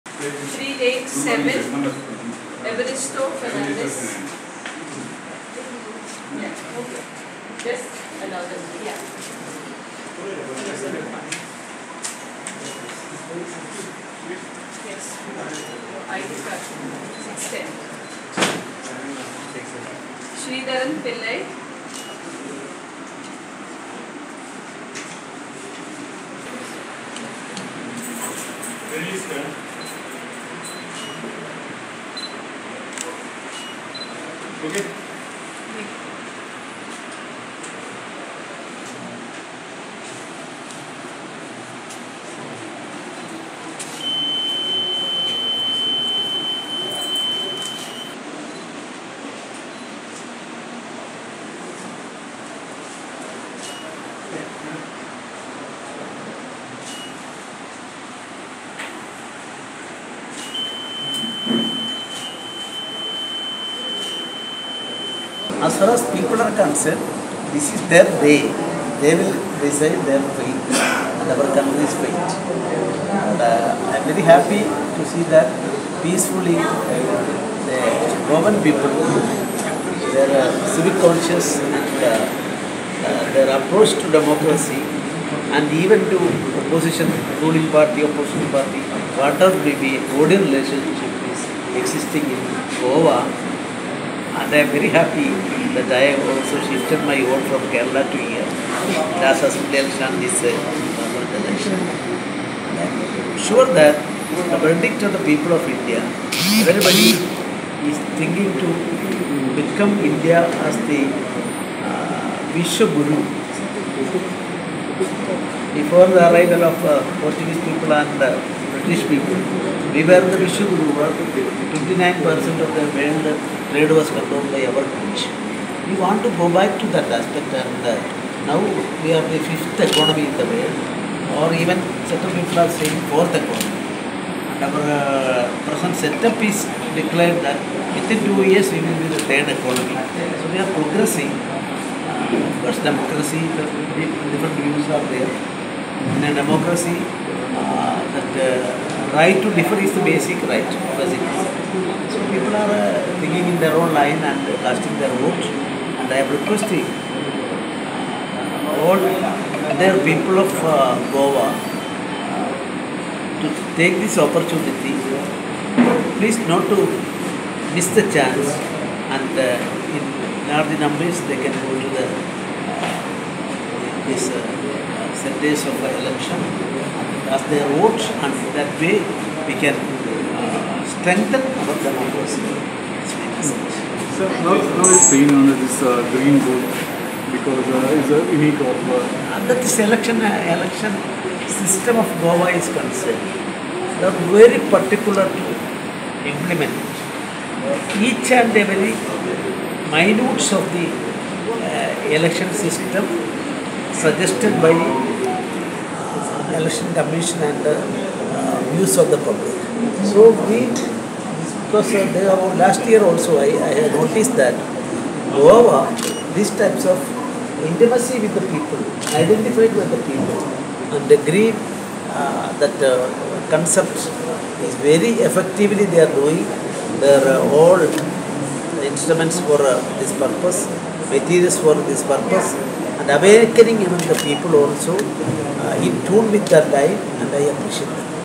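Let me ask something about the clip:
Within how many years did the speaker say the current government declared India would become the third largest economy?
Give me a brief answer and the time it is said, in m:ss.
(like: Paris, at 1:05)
2 years, at 2:18.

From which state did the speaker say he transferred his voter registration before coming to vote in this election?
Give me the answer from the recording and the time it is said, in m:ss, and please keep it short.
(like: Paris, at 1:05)
Kerala, at 1:37.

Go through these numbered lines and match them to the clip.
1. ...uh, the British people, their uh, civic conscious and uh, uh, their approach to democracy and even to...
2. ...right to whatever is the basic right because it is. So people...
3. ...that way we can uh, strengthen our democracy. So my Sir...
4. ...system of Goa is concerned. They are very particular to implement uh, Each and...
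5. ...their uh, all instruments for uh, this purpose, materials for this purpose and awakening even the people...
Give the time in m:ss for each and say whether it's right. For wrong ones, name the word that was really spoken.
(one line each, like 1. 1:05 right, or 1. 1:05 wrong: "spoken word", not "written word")
1. 1:16 wrong: "Roman", not "British"
2. 2:29 wrong: "differ", not "whatever"
3. 2:58 right
4. 3:11 right
5. 3:46 right.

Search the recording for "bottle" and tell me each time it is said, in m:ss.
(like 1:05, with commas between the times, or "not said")
not said.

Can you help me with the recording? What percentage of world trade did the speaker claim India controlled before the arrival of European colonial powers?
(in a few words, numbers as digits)
29%.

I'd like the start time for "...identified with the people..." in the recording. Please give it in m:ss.
3:39.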